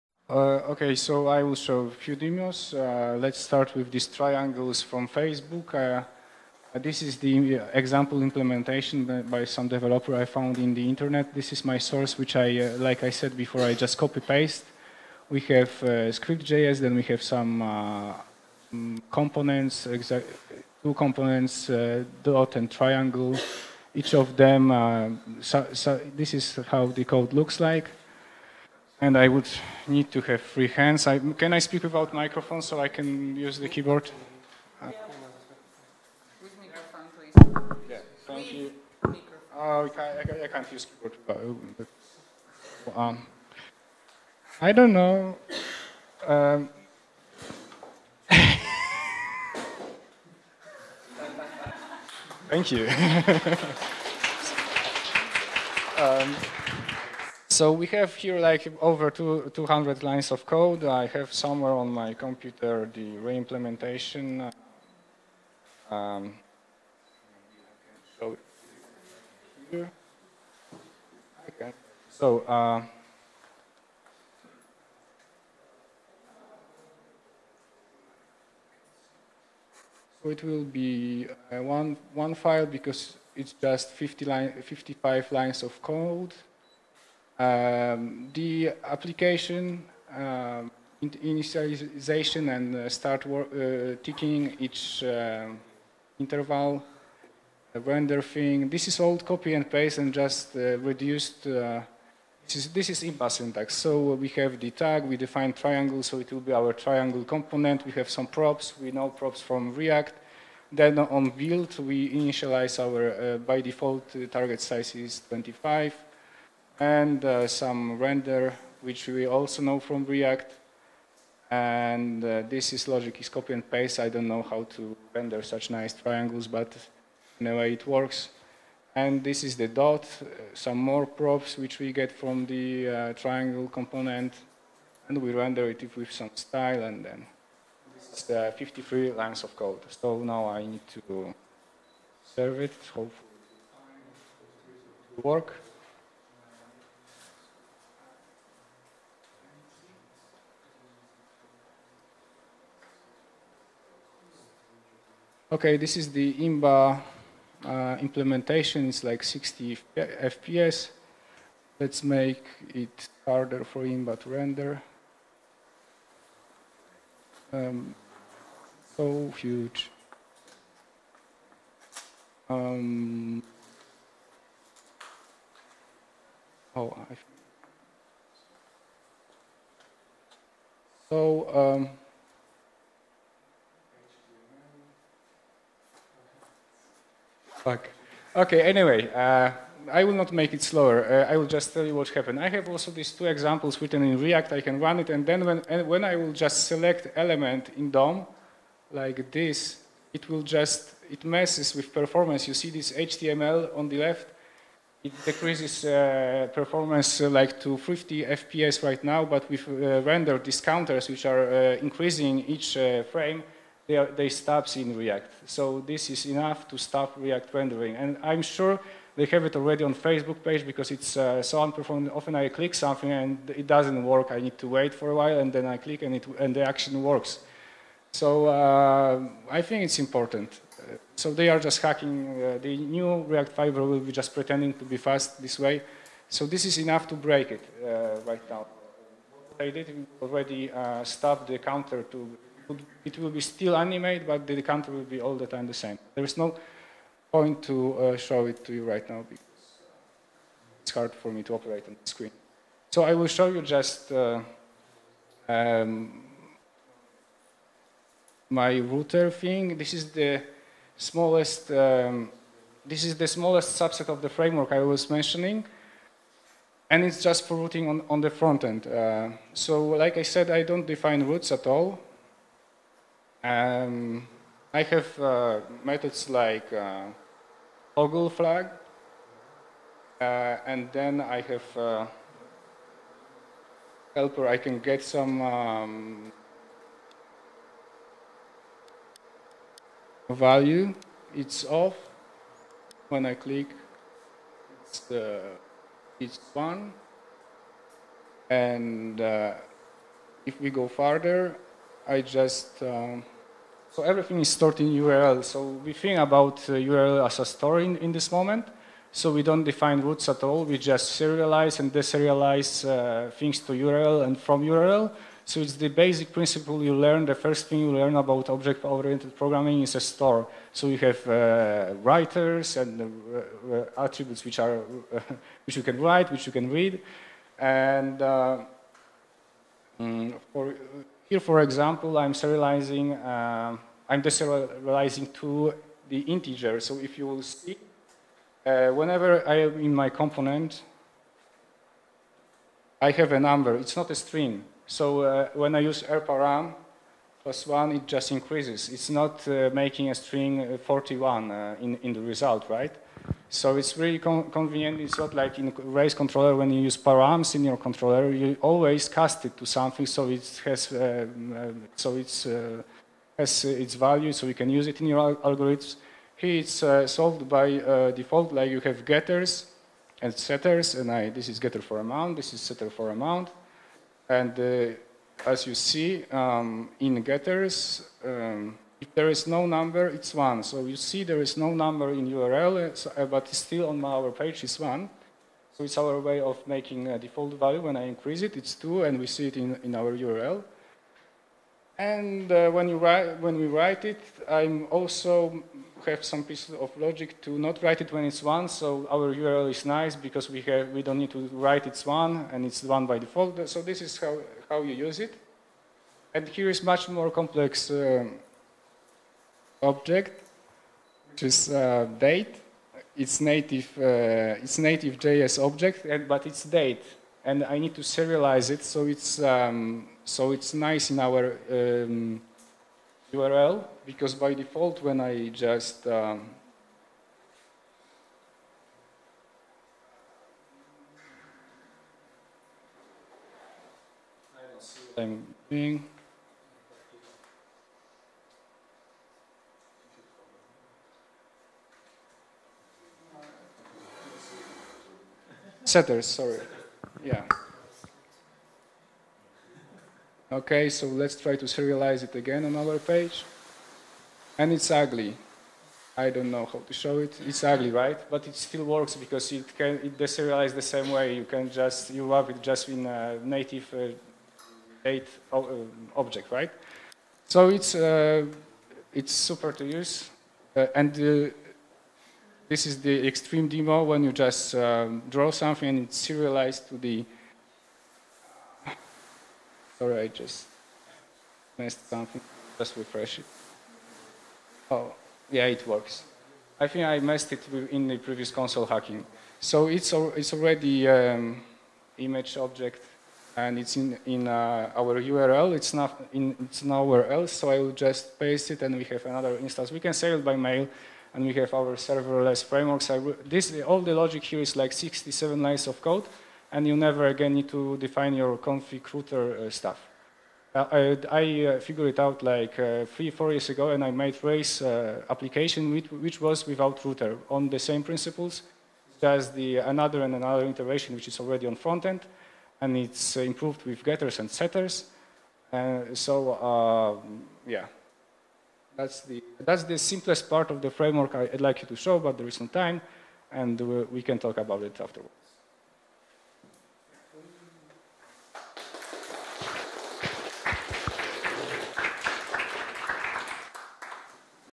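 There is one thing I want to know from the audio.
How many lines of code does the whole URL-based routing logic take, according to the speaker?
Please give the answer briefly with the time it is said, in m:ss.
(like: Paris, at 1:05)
67, at 8:24.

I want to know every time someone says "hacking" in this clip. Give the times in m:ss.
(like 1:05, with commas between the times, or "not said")
3:51, 8:08.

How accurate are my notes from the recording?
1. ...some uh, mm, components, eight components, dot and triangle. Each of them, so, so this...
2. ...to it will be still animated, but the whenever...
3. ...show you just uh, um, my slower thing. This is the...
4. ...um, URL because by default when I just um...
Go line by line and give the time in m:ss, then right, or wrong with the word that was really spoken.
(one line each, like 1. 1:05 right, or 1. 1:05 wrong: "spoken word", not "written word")
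1. 0:17 wrong: "two", not "eight"
2. 4:02 wrong: "counter", not "whenever"
3. 4:13 wrong: "router", not "slower"
4. 7:01 right.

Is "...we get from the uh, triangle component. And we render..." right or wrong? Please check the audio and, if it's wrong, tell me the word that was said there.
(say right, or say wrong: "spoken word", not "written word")
right.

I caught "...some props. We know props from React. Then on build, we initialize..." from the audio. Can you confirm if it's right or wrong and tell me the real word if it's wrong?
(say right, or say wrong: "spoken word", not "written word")
right.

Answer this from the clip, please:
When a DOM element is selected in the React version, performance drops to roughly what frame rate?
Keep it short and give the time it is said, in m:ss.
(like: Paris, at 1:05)
50 FPS, at 3:27.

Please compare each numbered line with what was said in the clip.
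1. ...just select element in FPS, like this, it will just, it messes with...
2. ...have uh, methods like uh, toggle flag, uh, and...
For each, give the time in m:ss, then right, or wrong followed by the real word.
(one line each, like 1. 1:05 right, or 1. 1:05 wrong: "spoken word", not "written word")
1. 3:16 wrong: "DOM", not "FPS"
2. 4:34 right.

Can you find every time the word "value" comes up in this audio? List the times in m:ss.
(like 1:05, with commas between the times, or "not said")
4:50, 6:03, 6:27.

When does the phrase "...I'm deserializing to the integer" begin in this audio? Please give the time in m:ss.
5:34.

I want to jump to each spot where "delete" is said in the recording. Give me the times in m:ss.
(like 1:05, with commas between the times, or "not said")
not said.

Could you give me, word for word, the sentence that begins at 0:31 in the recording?
I, can I speak without microphone so I can use the keyboard?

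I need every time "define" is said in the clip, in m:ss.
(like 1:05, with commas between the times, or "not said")
1:45, 4:30, 5:09, 8:27.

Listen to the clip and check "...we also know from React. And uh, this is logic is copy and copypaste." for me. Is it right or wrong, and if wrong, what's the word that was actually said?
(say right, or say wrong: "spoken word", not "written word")
wrong: "paste", not "copypaste".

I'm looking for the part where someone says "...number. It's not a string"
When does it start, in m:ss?
5:43.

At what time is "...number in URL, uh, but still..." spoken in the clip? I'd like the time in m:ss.
6:21.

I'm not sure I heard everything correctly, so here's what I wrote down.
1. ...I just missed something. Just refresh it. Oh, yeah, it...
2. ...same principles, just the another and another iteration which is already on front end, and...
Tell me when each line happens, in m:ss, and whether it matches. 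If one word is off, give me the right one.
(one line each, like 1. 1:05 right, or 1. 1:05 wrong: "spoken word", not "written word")
1. 8:00 right
2. 8:37 right.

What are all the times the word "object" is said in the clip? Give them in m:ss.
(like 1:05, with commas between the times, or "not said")
5:18, 6:49, 6:55, 7:46, 8:12.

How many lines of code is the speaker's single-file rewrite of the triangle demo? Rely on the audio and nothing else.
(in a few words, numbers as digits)
55.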